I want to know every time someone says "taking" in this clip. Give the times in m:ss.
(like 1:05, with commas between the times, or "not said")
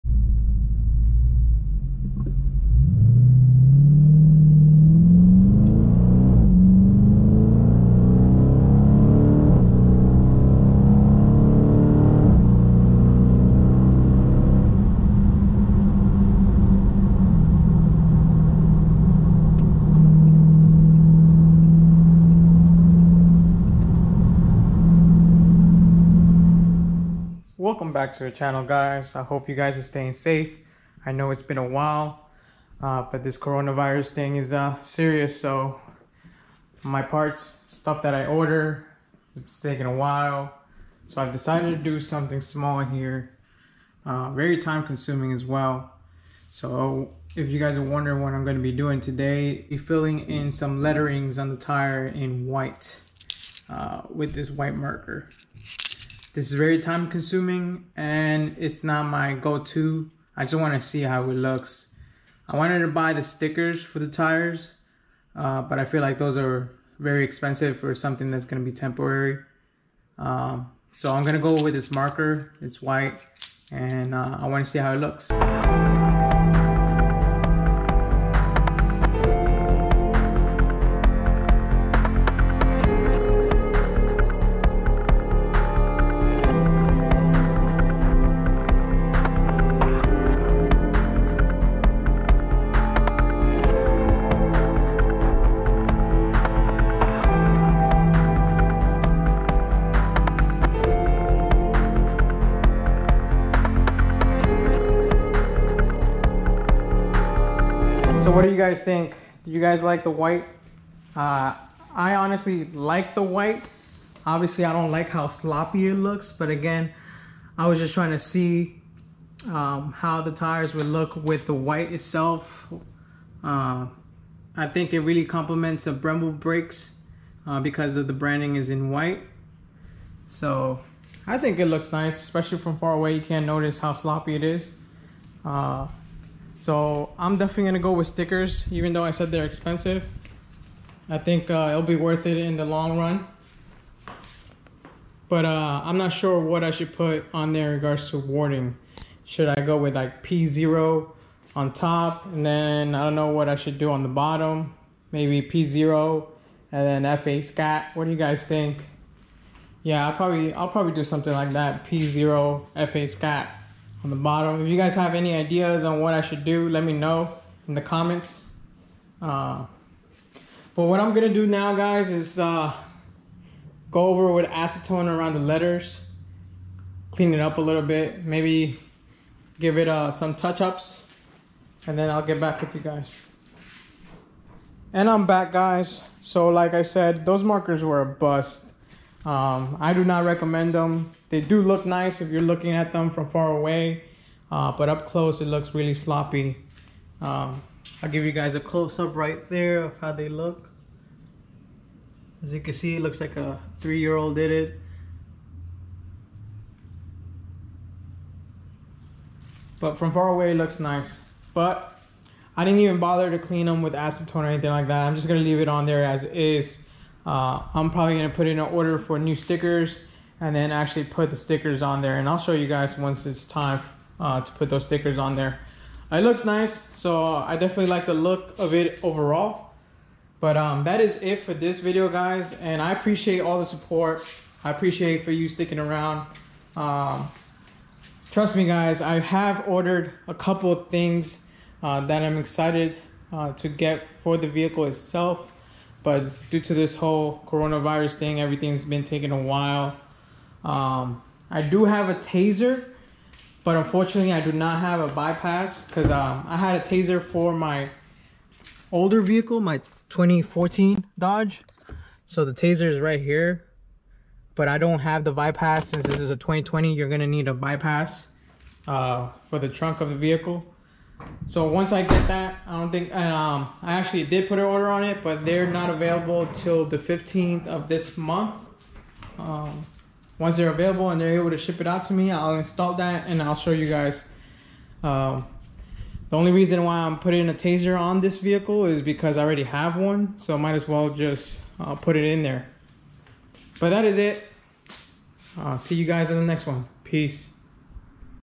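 0:39, 4:09.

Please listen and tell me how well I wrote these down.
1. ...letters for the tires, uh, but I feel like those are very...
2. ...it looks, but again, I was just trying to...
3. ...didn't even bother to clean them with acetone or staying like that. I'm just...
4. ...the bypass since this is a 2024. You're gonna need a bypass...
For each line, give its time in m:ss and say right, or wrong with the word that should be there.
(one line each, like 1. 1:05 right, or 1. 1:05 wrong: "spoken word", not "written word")
1. 1:03 wrong: "stickers", not "letters"
2. 1:55 right
3. 3:32 wrong: "anything", not "staying"
4. 4:25 wrong: "2020", not "2024".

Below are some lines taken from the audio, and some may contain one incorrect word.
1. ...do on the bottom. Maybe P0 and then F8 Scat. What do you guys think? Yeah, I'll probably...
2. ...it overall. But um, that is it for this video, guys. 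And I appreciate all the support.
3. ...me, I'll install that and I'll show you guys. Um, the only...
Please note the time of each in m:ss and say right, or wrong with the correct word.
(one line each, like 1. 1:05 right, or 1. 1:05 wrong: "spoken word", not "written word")
1. 2:33 right
2. 3:48 right
3. 4:42 right.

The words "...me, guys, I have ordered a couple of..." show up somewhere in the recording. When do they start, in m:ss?
3:58.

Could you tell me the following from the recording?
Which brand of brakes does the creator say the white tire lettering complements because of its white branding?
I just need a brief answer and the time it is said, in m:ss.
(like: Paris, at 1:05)
Brembo, at 2:05.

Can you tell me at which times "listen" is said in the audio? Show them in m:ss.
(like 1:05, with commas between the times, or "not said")
not said.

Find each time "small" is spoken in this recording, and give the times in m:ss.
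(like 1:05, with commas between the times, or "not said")
0:42.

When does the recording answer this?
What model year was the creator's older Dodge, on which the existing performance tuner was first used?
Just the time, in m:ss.
4:20.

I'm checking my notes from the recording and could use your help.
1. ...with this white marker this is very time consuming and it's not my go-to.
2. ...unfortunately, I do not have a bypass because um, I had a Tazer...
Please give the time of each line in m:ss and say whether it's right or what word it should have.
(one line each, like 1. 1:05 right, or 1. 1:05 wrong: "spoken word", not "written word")
1. 0:54 right
2. 4:13 right.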